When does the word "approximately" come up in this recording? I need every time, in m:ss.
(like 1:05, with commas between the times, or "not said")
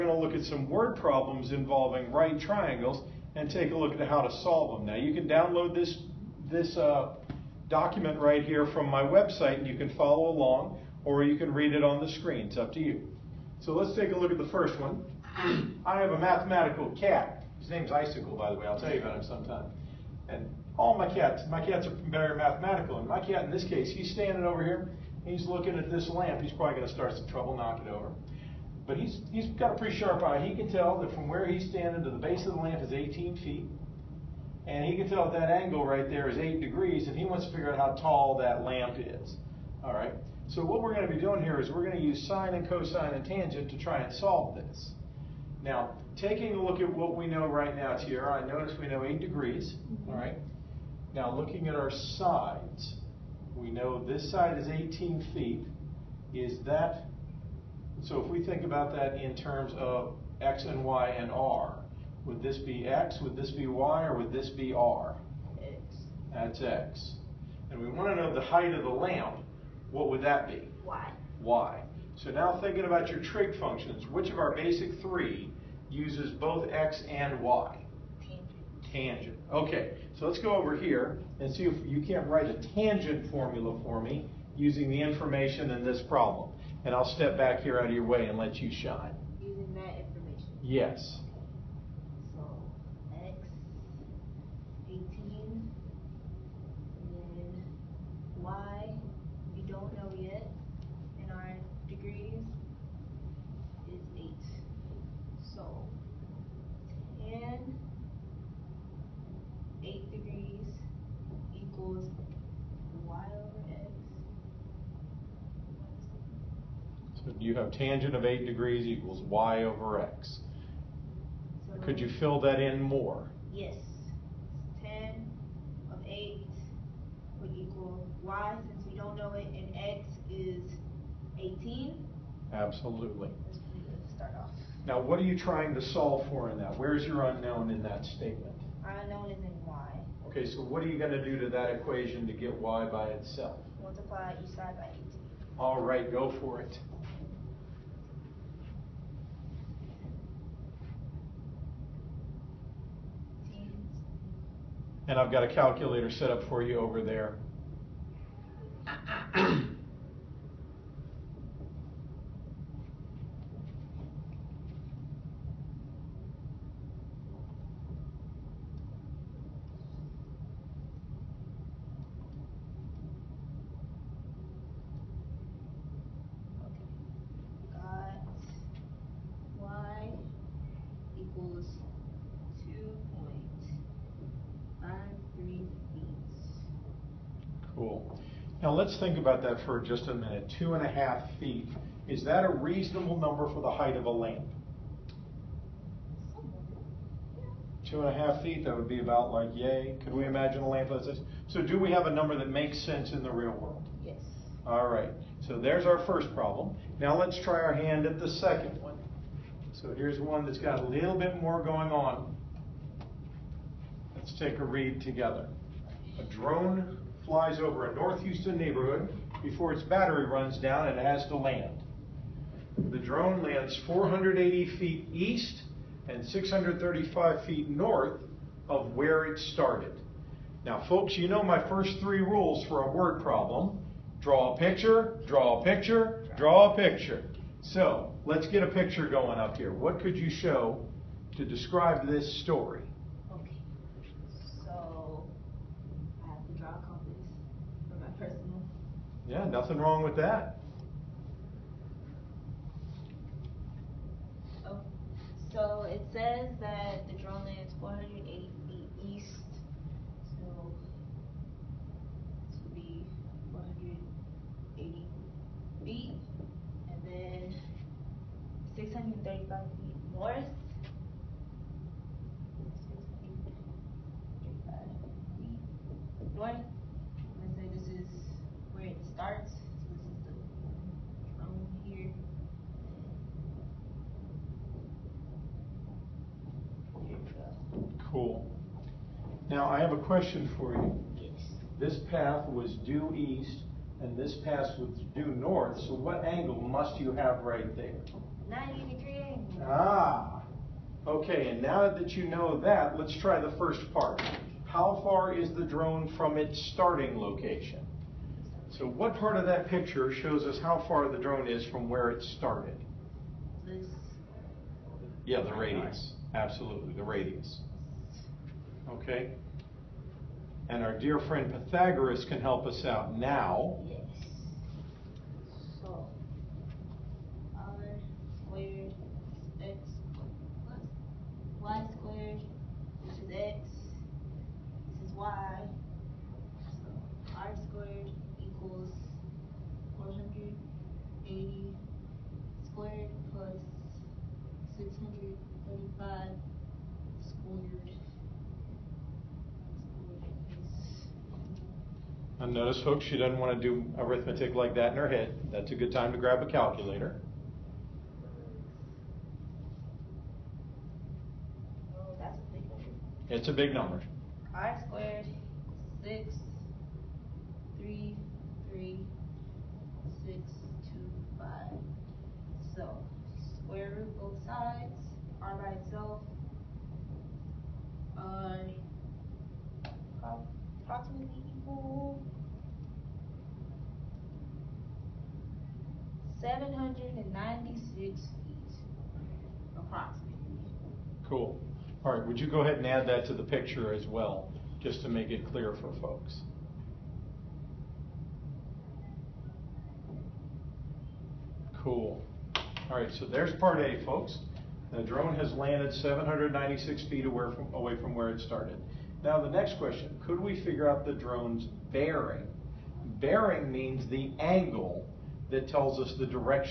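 6:20, 6:29.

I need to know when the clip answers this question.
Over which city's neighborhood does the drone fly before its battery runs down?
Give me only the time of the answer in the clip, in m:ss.
3:37.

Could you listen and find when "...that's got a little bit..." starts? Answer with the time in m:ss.
3:30.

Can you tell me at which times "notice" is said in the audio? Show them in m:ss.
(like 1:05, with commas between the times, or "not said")
0:48, 5:52.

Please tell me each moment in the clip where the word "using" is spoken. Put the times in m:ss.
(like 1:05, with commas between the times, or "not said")
1:24, 1:29.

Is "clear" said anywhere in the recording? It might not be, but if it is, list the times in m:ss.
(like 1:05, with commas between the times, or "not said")
6:35.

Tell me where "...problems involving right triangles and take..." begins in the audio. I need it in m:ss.
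0:00.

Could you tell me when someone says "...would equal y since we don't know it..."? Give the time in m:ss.
2:07.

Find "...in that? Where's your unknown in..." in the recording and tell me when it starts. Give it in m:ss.
2:16.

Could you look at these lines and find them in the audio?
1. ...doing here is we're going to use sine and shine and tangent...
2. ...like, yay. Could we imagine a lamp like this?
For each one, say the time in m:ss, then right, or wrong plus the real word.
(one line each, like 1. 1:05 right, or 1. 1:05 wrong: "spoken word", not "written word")
1. 0:41 wrong: "cosine", not "shine"
2. 3:19 right.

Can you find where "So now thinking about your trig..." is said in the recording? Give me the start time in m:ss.
1:12.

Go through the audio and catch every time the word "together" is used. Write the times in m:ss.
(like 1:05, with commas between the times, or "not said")
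3:35.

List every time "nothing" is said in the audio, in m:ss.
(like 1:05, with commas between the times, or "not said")
4:09.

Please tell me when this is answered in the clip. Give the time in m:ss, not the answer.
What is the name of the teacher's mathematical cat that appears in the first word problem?
0:17.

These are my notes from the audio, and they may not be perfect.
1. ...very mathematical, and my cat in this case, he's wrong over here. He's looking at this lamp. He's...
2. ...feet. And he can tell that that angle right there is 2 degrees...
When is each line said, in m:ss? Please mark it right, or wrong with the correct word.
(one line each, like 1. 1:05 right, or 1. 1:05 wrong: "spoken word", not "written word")
1. 0:22 wrong: "standing", not "wrong"
2. 0:33 wrong: "8", not "2".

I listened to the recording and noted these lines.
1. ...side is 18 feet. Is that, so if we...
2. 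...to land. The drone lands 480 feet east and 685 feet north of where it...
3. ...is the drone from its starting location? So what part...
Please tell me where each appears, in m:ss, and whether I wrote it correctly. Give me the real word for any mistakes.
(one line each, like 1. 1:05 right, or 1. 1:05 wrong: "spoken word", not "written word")
1. 0:54 right
2. 3:41 wrong: "635", not "685"
3. 5:05 right.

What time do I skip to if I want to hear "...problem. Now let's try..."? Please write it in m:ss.
3:26.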